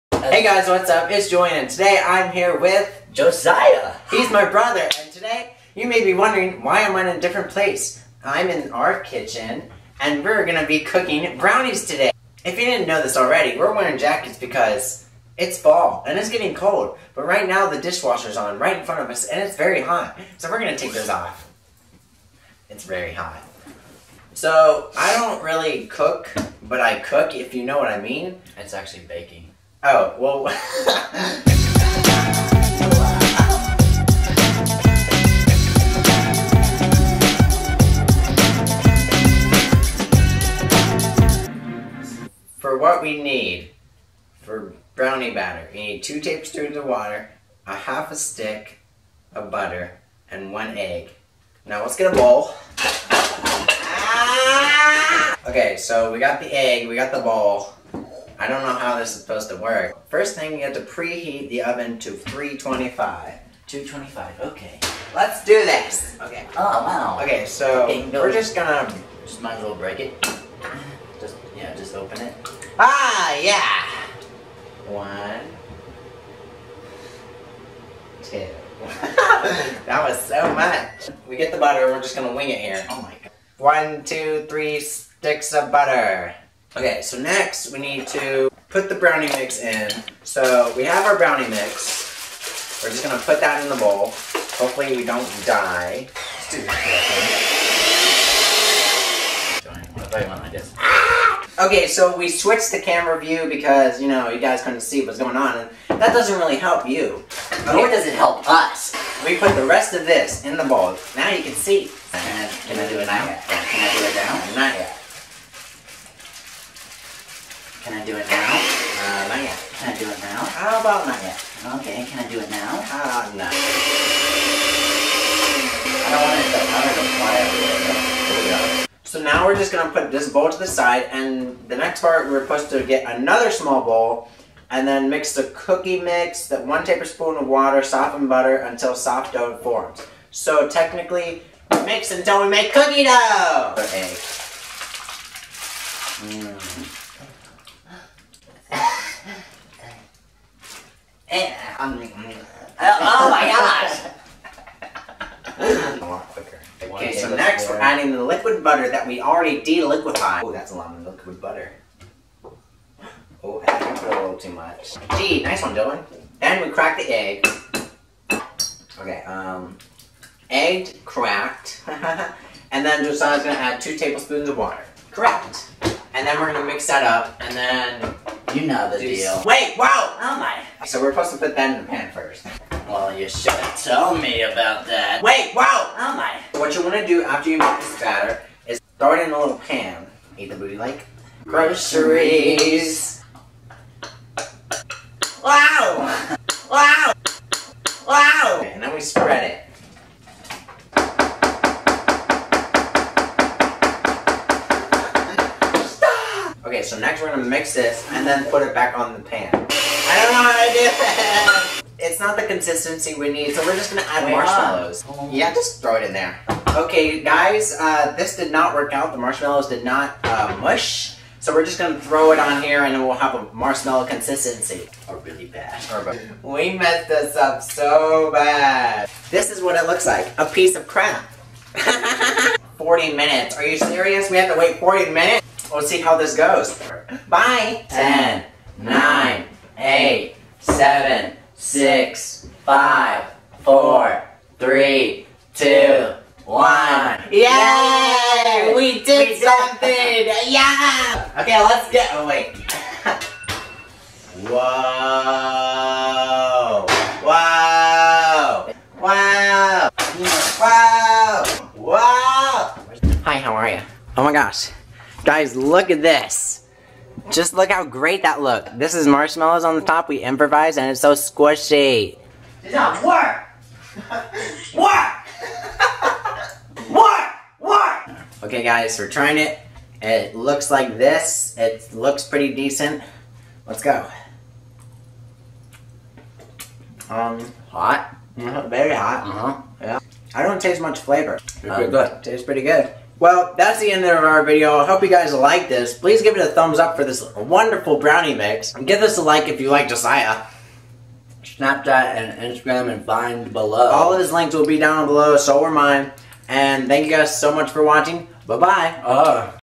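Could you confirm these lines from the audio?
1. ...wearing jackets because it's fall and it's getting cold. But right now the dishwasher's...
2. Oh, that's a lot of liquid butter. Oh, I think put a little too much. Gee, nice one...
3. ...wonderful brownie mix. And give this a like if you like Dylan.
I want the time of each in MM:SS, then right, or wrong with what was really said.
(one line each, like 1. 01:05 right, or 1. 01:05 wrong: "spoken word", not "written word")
1. 00:13 right
2. 02:40 right
3. 04:57 wrong: "Josiah", not "Dylan".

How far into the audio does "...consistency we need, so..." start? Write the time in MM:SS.
03:32.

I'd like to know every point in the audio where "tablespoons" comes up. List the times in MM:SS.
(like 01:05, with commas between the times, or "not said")
00:46, 02:16, 02:53.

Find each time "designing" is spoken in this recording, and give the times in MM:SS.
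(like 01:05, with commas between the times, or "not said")
not said.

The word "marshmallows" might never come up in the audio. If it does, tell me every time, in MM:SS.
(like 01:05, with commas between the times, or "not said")
03:34, 03:39, 03:43, 04:29.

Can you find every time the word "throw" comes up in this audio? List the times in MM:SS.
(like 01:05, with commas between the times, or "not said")
03:08, 03:35, 03:41.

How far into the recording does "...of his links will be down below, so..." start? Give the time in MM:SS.
05:04.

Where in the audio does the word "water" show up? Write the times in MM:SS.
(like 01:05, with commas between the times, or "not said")
00:46, 02:17, 02:54.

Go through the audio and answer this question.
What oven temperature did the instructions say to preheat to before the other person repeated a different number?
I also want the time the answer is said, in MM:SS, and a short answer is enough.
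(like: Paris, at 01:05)
325, at 01:02.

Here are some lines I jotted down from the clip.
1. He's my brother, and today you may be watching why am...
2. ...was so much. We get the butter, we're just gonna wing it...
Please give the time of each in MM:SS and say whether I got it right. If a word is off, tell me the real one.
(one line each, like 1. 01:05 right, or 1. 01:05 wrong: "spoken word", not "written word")
1. 00:04 wrong: "wondering", not "watching"
2. 01:20 right.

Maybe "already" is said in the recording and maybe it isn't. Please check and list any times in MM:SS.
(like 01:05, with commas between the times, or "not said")
00:13, 02:39.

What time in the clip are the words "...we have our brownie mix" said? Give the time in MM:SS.
01:30.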